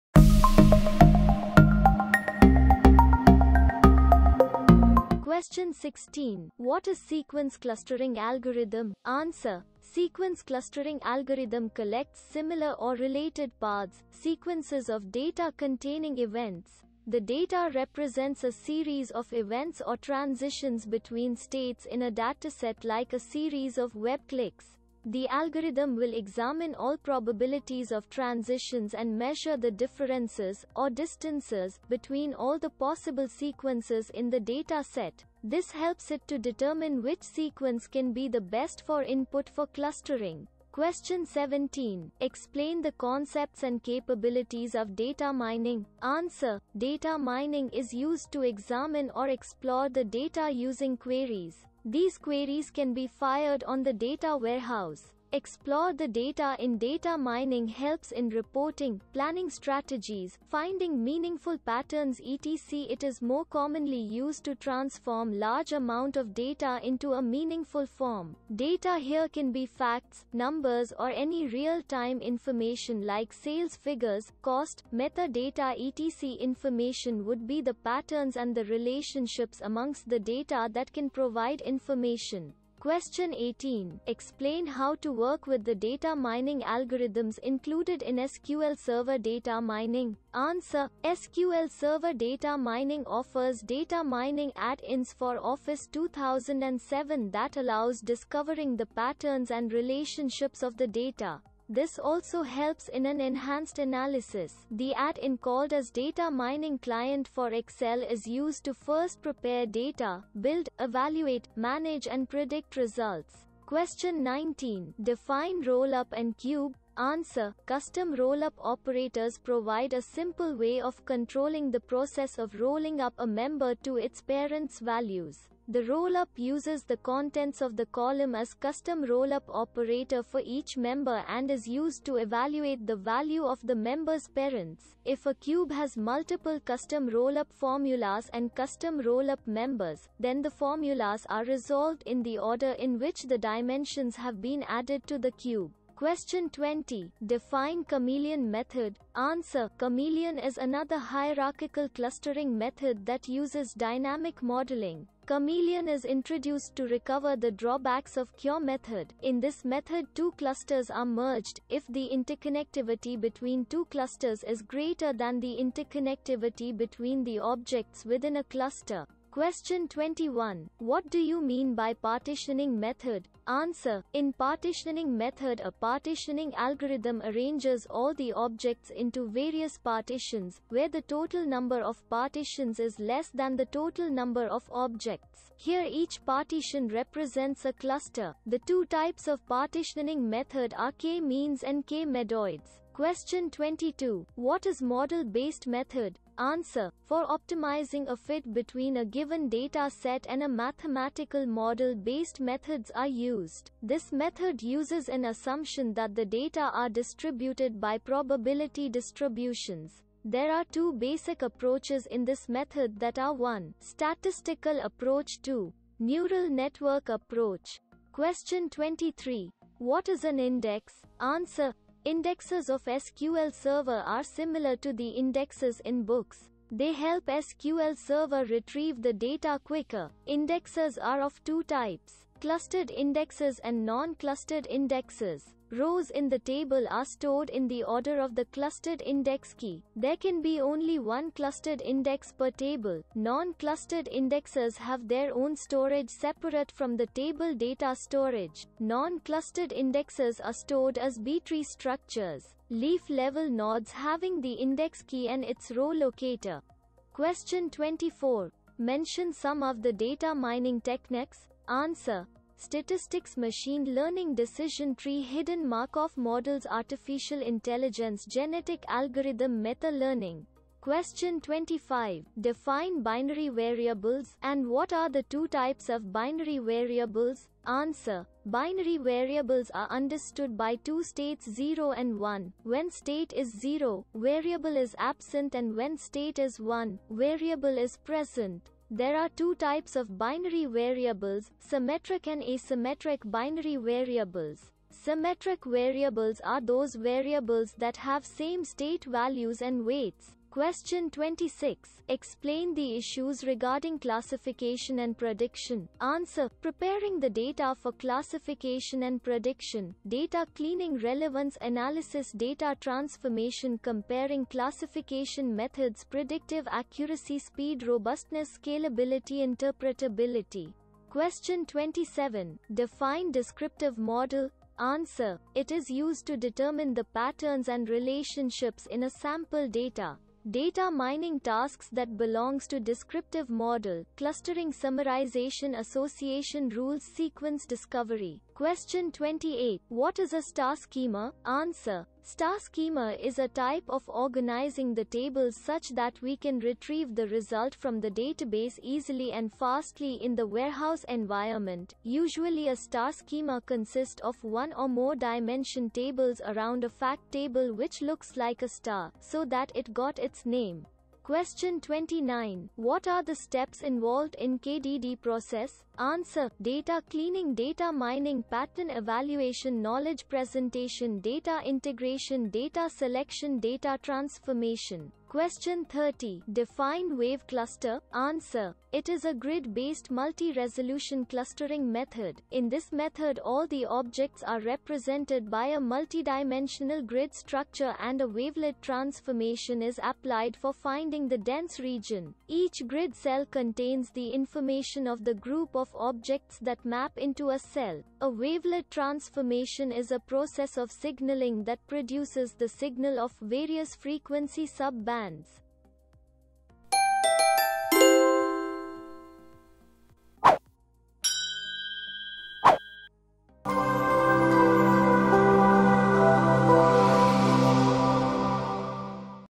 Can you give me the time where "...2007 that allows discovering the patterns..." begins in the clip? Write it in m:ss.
1:35.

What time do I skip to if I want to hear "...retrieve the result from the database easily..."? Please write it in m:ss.
5:46.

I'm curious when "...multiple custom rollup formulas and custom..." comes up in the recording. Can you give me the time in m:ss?
2:15.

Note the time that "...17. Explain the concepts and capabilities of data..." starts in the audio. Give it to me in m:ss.
0:41.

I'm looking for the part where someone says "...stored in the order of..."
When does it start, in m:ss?
3:57.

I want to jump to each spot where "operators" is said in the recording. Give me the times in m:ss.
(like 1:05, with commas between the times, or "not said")
1:58, 2:09.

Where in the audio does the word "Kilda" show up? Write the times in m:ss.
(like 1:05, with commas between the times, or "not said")
not said.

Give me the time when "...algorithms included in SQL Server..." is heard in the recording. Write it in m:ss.
1:26.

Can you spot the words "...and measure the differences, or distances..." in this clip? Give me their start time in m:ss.
0:28.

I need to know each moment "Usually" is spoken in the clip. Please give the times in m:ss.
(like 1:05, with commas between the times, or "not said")
5:52.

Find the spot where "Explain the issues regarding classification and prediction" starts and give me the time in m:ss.
5:02.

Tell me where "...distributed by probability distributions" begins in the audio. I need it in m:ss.
3:26.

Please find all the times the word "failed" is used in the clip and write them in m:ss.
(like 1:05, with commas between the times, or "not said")
not said.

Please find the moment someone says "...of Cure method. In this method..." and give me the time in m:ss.
2:38.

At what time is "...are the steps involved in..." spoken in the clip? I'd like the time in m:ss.
6:03.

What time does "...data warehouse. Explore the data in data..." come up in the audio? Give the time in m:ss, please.
0:53.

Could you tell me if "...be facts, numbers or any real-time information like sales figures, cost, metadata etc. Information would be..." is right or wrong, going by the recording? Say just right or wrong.
right.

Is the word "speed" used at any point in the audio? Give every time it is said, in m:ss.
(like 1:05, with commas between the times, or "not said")
5:17.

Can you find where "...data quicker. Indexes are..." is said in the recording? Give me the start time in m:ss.
3:49.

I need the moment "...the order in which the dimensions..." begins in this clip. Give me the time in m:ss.
2:22.